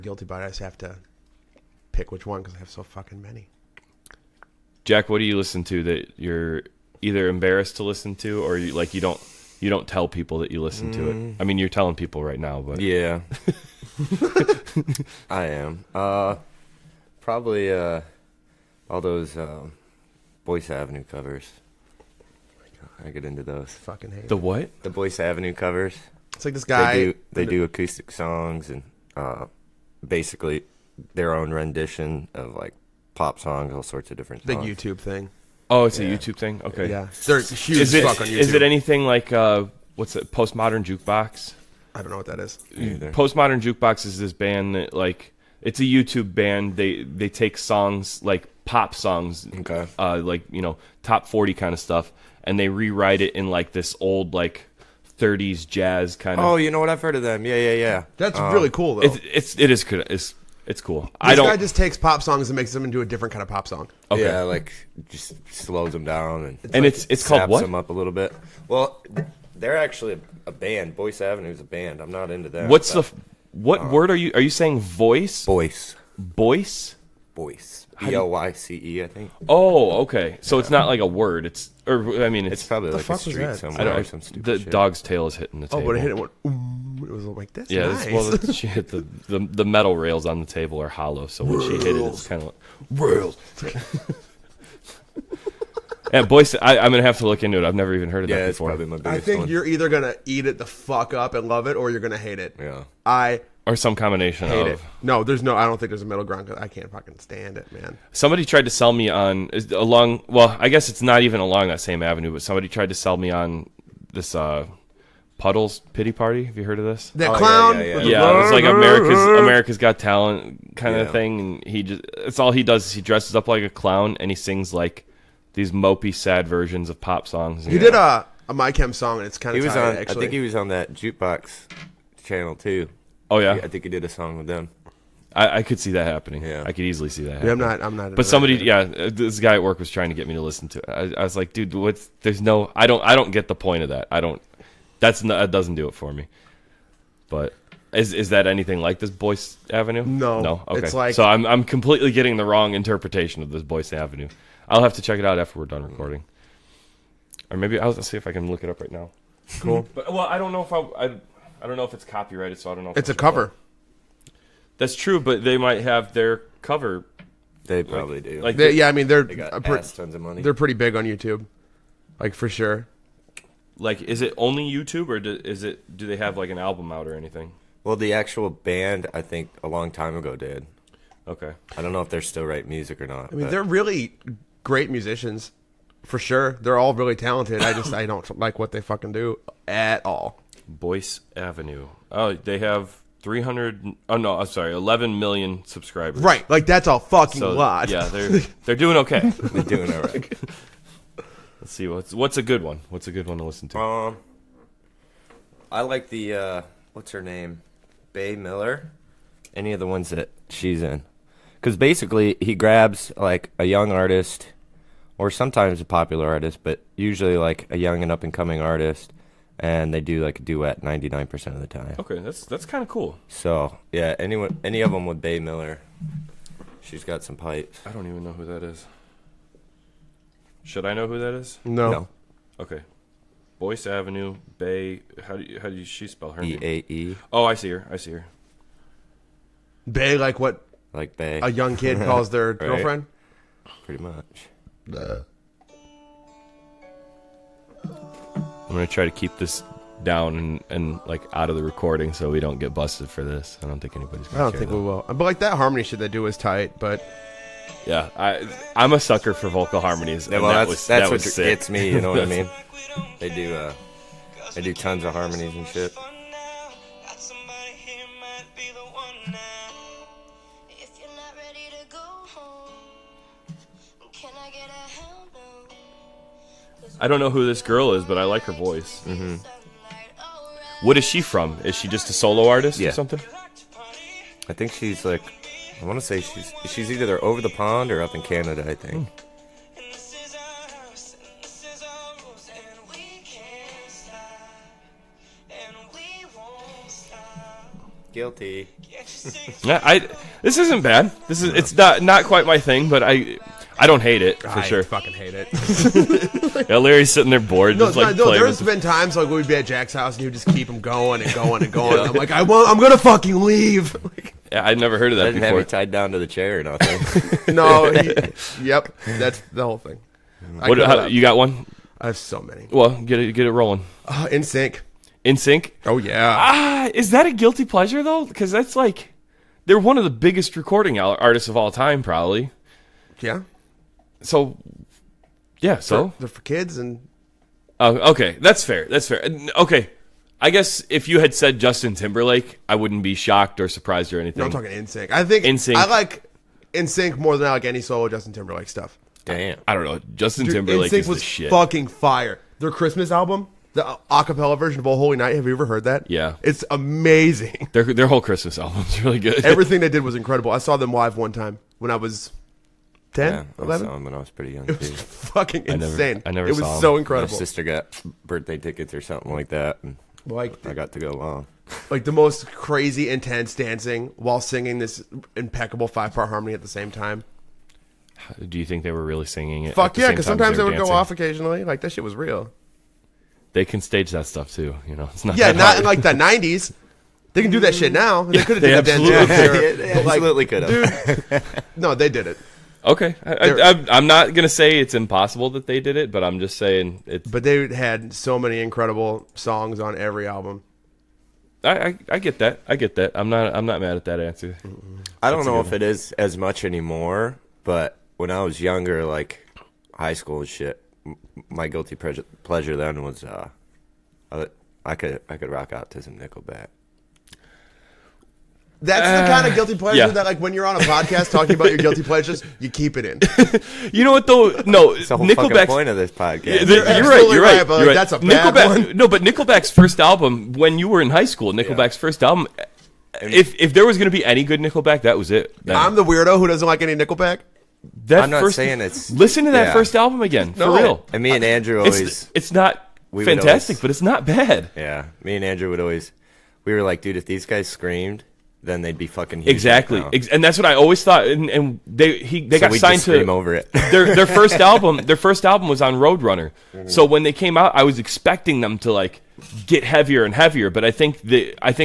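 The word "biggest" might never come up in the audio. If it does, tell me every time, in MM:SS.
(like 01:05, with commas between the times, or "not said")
01:38, 05:30.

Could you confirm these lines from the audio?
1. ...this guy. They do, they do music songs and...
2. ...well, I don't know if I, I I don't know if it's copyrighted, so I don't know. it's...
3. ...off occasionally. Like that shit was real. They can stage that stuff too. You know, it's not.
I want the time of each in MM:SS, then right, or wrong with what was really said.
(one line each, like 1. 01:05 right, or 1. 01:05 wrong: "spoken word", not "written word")
1. 00:26 wrong: "acoustic", not "music"
2. 02:40 right
3. 06:20 right.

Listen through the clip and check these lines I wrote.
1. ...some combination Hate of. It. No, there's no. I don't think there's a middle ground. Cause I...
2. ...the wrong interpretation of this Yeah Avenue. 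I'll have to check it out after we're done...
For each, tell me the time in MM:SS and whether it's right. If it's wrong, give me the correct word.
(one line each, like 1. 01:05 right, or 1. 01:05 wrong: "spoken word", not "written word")
1. 01:43 right
2. 02:32 wrong: "Boyce", not "Yeah".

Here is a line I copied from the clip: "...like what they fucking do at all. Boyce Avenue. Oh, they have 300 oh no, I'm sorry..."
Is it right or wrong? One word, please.
right.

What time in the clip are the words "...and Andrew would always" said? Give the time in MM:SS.
07:25.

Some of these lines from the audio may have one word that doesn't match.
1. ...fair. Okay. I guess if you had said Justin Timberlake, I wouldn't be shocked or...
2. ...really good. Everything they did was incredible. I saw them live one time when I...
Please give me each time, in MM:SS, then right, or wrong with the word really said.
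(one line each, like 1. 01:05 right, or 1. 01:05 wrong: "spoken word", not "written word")
1. 05:39 right
2. 05:59 right.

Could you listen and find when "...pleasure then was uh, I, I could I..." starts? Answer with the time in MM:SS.
06:52.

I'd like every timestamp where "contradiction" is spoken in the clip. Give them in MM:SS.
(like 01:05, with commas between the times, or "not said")
not said.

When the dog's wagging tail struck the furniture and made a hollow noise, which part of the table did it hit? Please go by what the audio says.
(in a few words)
metal rails.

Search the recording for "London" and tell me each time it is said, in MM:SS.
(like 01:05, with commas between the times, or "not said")
not said.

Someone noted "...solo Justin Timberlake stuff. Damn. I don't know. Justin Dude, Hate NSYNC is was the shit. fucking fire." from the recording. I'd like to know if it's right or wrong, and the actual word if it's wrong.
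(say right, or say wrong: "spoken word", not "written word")
wrong: "Timberlake", not "Hate".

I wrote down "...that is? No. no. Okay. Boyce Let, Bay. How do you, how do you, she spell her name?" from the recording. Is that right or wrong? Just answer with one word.
wrong.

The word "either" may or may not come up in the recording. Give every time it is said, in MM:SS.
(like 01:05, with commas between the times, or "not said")
00:07, 00:42, 01:39, 04:46.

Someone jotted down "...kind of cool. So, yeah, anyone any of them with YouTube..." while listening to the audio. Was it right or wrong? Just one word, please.
wrong.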